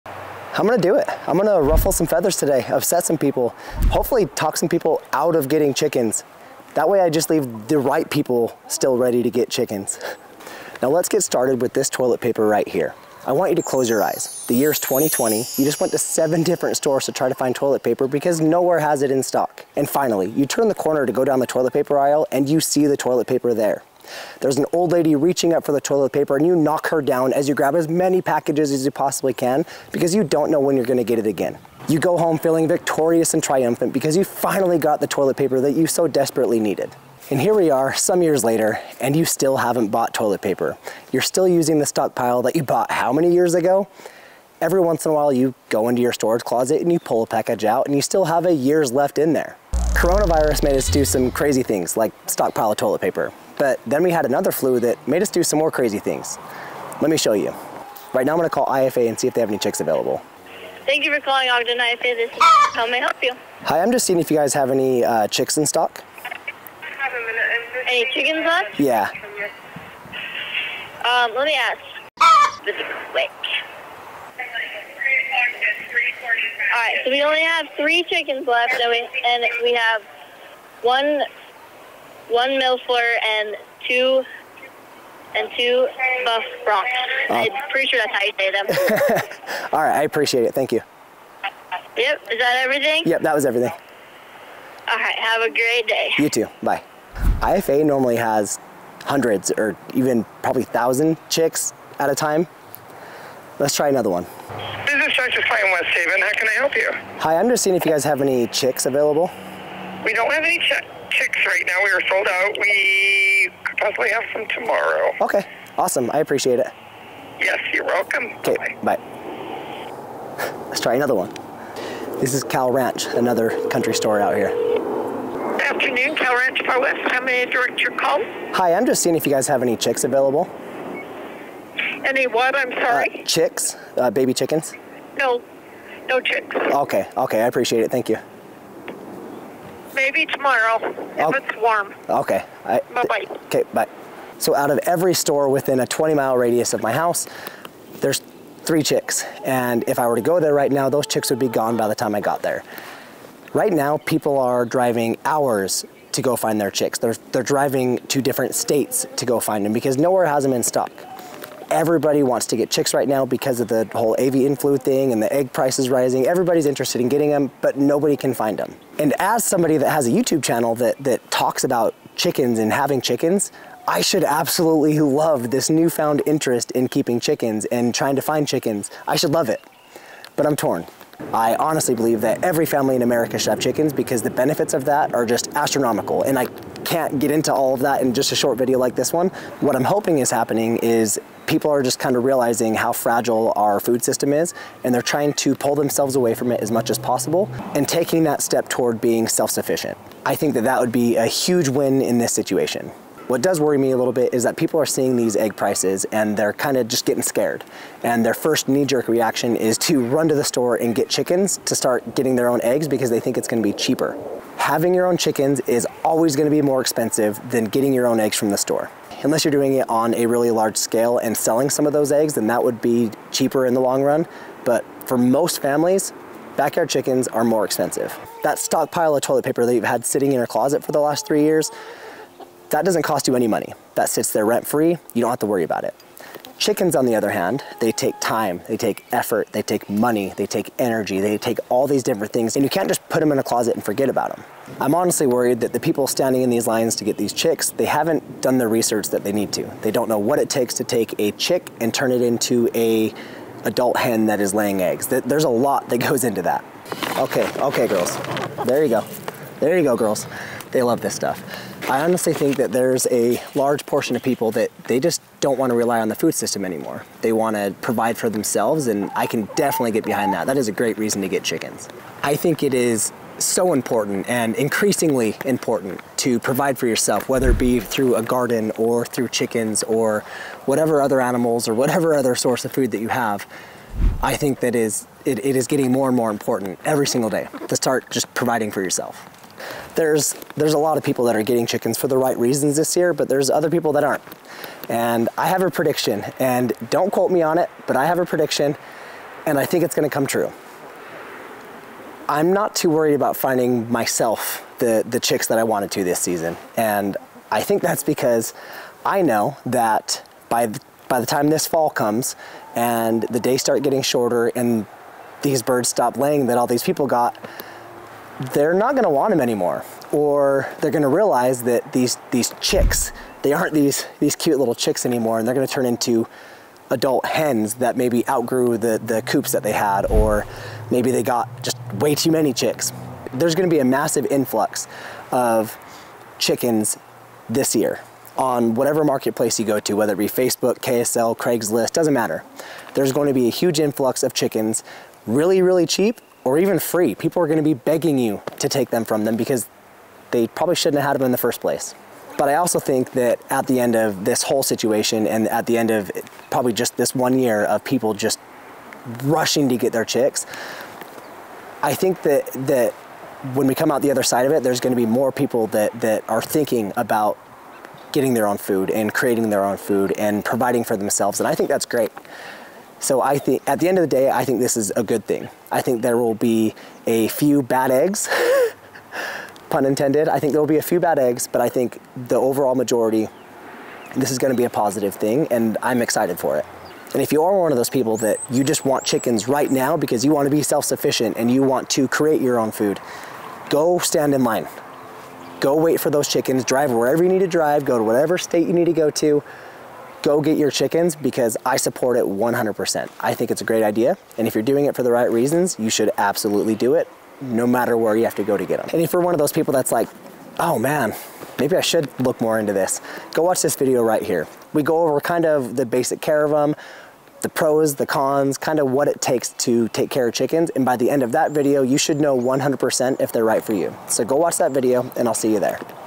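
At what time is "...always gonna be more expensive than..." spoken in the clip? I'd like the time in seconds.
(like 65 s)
216 s.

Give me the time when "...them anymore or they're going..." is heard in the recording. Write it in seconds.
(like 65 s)
319 s.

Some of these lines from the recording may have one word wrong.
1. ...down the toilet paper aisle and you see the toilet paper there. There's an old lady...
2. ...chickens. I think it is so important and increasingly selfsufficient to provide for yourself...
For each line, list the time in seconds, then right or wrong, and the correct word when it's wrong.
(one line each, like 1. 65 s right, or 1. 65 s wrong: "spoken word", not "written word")
1. 21 s right
2. 271 s wrong: "important", not "selfsufficient".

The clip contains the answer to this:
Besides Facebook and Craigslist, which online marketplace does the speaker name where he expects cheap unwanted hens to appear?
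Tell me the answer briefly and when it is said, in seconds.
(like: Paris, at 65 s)
KSL, at 340 s.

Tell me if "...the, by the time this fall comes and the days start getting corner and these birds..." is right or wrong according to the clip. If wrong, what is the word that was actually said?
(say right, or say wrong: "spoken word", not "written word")
wrong: "shorter", not "corner".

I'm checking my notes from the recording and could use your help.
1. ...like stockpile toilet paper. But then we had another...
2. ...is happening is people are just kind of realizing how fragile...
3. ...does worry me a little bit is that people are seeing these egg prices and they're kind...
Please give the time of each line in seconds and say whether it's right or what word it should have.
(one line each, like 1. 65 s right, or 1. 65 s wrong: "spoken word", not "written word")
1. 51 s right
2. 190 s right
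3. 203 s right.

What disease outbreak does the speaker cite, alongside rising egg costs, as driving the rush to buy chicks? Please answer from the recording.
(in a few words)
avian flu.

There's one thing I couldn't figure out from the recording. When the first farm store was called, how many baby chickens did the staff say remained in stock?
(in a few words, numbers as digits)
3.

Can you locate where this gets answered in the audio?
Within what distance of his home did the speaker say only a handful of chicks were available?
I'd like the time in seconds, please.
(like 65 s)
145 s.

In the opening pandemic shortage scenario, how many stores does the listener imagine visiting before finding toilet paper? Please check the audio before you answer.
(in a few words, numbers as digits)
7.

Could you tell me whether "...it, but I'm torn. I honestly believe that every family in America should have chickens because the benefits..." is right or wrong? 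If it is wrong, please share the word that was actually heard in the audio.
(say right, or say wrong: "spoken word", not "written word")
right.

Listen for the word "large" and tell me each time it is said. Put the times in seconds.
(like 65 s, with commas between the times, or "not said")
220 s, 263 s.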